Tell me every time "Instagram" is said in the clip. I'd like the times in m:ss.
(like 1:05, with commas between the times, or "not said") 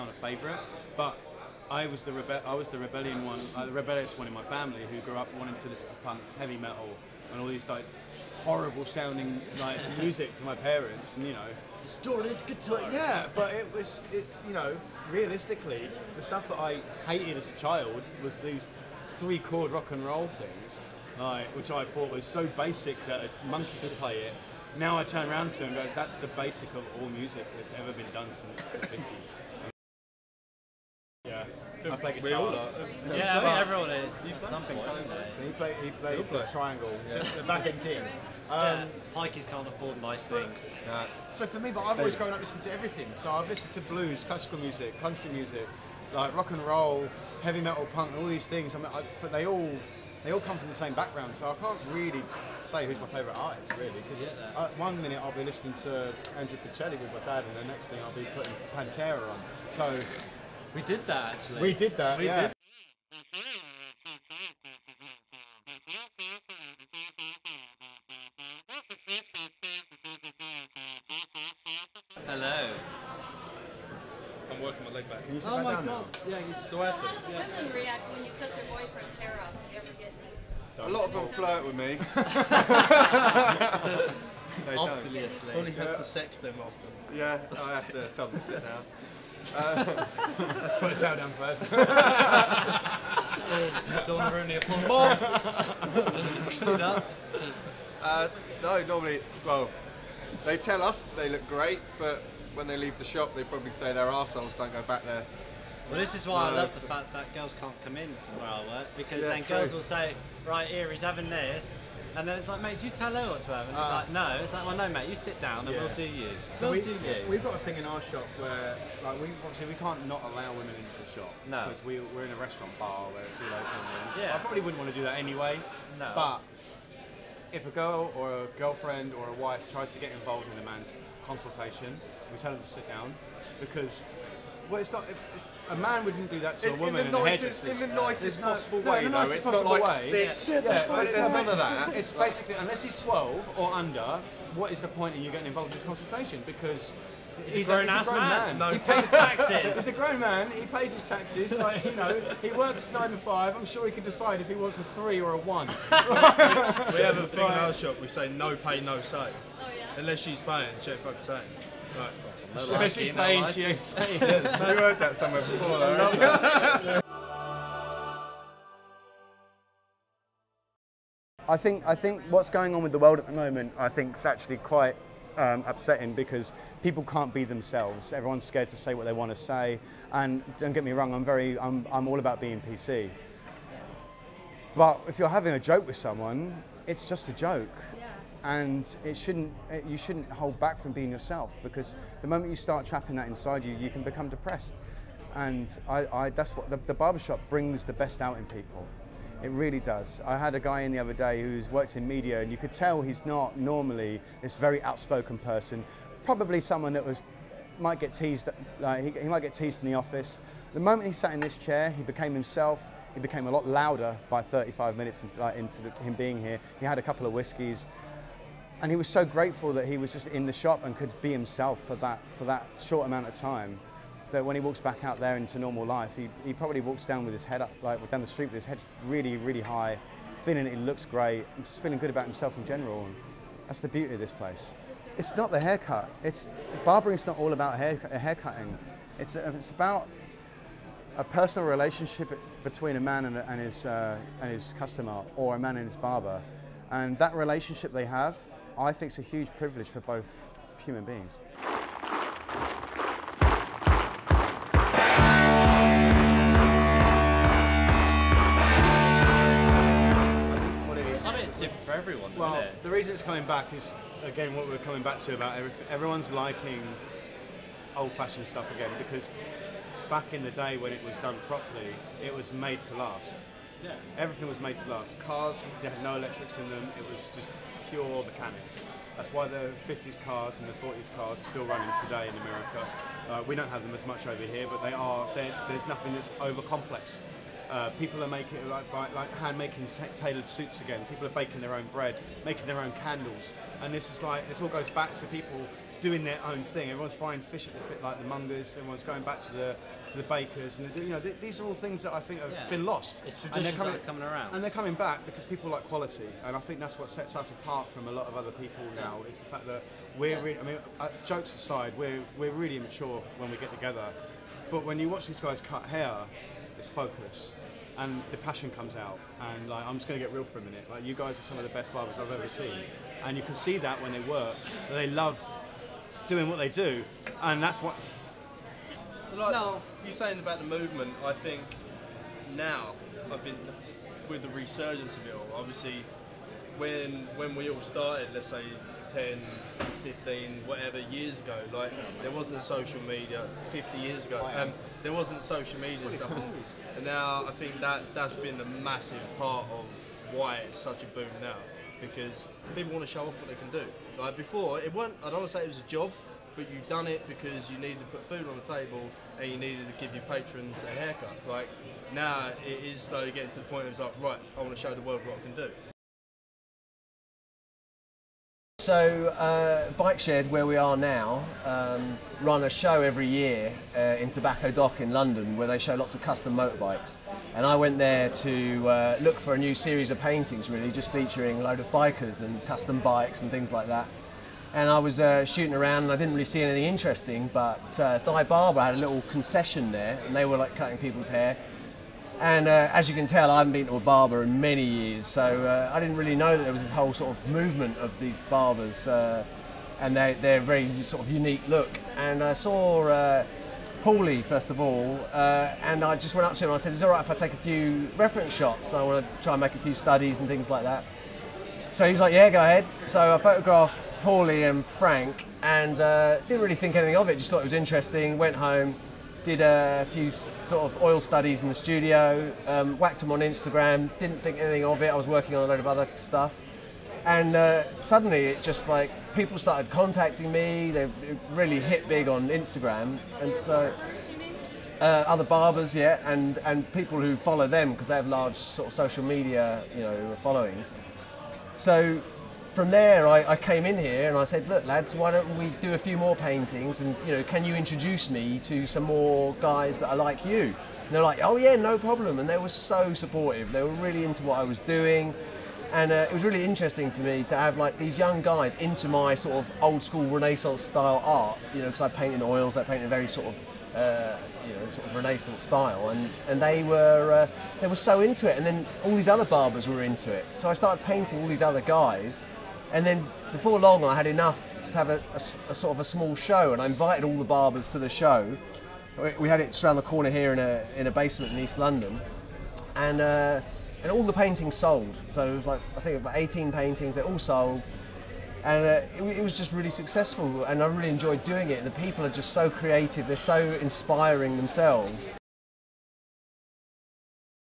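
7:03, 7:12.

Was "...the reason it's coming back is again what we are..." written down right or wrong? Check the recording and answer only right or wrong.
right.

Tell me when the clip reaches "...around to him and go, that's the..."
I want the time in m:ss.
0:25.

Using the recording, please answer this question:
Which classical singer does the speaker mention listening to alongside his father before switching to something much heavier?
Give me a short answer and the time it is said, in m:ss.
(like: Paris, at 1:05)
Andrea Bocelli, at 0:56.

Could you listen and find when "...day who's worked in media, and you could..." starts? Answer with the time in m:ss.
3:21.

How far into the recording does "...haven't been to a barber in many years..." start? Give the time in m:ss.
6:33.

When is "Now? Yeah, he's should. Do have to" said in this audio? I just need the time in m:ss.
1:16.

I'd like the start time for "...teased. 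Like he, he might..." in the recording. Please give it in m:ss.
3:28.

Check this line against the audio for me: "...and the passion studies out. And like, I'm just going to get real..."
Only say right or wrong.
wrong.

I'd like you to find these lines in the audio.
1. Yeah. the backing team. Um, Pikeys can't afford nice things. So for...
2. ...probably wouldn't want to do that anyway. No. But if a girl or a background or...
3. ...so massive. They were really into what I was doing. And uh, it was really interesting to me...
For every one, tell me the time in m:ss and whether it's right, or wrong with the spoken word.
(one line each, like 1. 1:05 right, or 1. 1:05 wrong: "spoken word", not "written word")
1. 0:37 right
2. 2:04 wrong: "girlfriend", not "background"
3. 7:32 wrong: "supportive", not "massive".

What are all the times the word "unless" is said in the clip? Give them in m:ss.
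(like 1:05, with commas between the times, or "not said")
2:22, 2:39.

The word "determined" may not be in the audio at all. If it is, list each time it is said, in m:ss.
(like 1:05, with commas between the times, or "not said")
not said.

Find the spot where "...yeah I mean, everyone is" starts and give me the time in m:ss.
0:33.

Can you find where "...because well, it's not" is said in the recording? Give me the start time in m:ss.
2:13.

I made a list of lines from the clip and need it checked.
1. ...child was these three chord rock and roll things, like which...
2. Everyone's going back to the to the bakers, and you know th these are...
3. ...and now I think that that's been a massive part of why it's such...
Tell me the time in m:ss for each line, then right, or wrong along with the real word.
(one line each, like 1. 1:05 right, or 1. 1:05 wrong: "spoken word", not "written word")
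1. 0:17 right
2. 4:58 right
3. 5:46 right.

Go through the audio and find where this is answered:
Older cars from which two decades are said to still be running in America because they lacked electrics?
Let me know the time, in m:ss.
4:39.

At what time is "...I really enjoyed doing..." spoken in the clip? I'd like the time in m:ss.
8:10.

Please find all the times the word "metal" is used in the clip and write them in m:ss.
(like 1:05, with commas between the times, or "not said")
0:06, 0:47.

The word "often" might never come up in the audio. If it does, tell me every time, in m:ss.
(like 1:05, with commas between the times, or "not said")
1:26.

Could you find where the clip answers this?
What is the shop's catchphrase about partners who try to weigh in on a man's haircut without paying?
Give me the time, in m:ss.
2:38.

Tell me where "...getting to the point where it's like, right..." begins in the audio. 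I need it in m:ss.
6:03.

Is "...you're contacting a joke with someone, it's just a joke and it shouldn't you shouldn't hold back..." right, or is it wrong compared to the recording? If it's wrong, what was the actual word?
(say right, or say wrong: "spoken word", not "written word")
wrong: "having", not "contacting".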